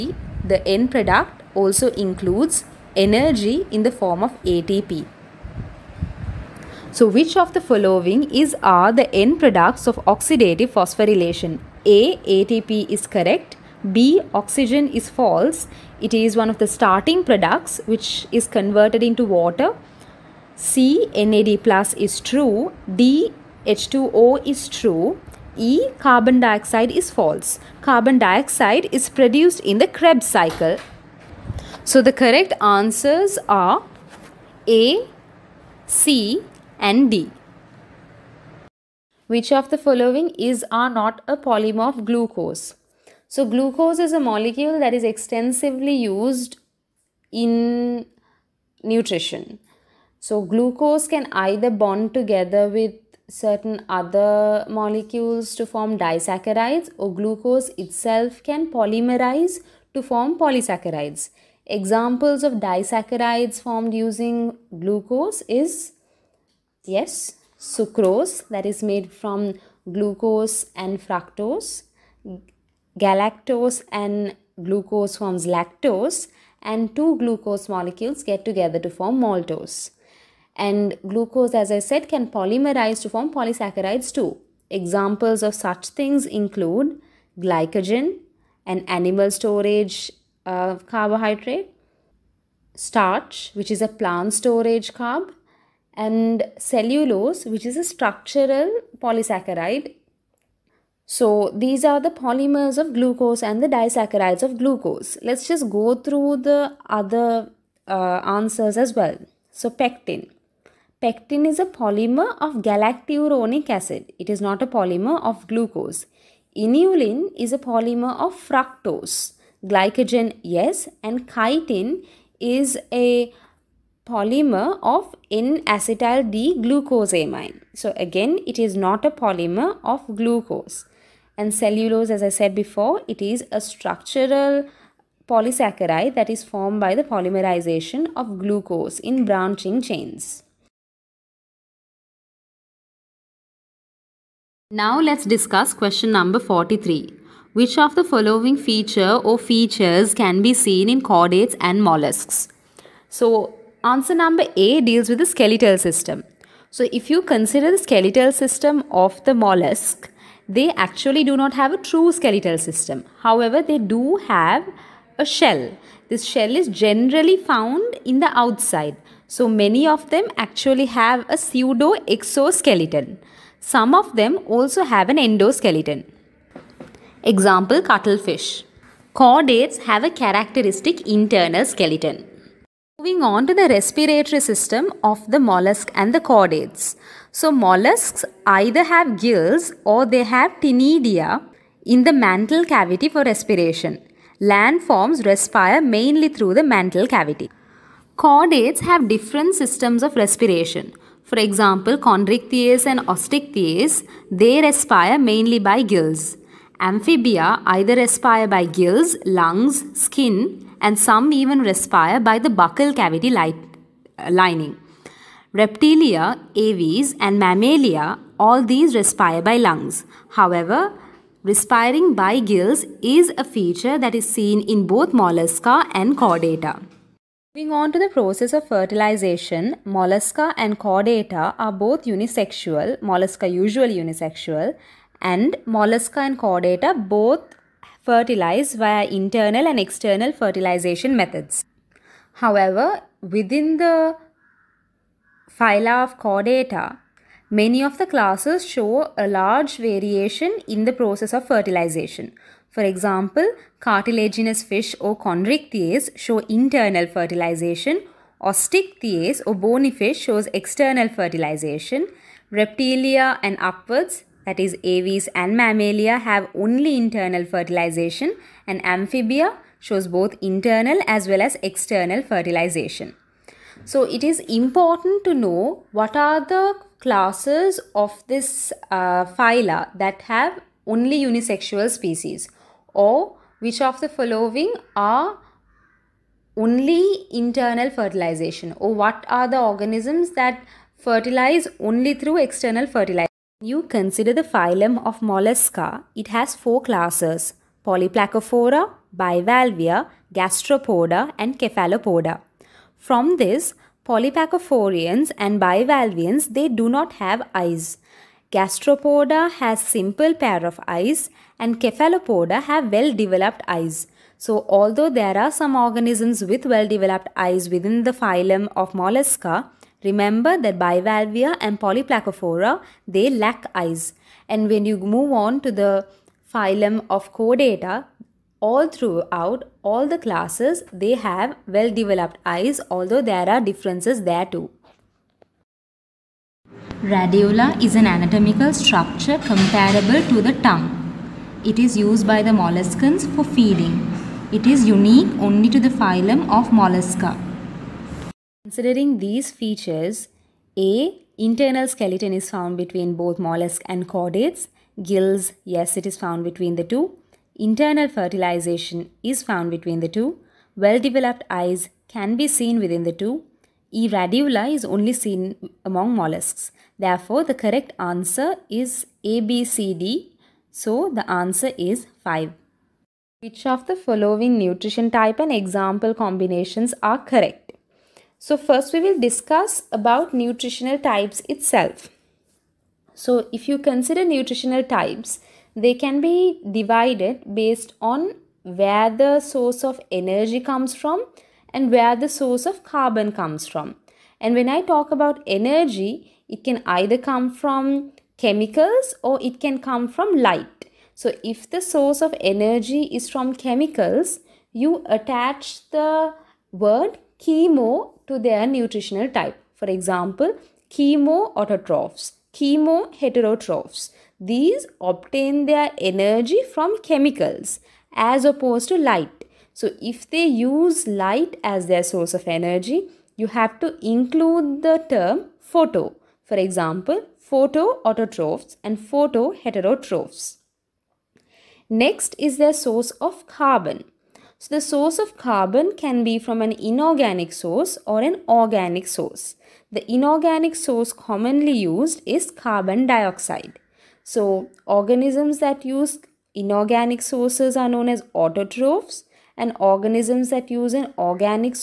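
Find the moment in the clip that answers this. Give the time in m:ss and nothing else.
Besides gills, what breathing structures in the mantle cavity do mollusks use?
3:10.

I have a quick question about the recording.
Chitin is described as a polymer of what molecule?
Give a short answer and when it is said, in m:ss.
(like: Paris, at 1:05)
N-acetyl D-glucosamine, at 2:05.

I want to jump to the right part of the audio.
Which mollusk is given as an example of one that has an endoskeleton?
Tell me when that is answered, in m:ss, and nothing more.
2:57.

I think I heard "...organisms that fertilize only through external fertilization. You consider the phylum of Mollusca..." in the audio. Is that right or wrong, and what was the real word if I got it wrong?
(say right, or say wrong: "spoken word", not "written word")
right.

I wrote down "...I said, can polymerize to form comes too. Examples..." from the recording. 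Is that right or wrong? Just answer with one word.
wrong.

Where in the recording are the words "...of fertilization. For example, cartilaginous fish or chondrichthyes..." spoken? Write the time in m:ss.
4:11.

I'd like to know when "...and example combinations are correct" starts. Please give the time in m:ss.
6:15.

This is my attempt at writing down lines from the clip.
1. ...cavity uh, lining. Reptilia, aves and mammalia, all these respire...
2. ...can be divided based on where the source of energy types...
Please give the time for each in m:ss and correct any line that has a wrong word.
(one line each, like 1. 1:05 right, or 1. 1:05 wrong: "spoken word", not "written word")
1. 3:32 right
2. 6:25 wrong: "comes", not "types".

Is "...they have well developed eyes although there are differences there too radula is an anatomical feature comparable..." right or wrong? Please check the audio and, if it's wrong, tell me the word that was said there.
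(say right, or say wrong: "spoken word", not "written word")
wrong: "structure", not "feature".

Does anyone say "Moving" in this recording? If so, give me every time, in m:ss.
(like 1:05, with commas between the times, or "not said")
3:02, 3:47.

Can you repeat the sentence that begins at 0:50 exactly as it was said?
So, glucose can either bond together with certain other molecules to form disaccharides, or glucose itself can polymerize to form polysaccharides.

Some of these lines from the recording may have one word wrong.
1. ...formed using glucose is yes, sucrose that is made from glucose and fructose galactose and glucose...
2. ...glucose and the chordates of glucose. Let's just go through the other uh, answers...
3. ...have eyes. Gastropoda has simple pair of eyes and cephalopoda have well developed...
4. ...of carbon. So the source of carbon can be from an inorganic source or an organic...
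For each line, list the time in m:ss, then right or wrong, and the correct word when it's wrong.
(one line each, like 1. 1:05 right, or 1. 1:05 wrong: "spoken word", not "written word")
1. 1:03 right
2. 1:42 wrong: "disaccharides", not "chordates"
3. 5:07 right
4. 7:13 right.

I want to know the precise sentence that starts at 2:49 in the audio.
So many of them actually have a pseudo exoskeleton.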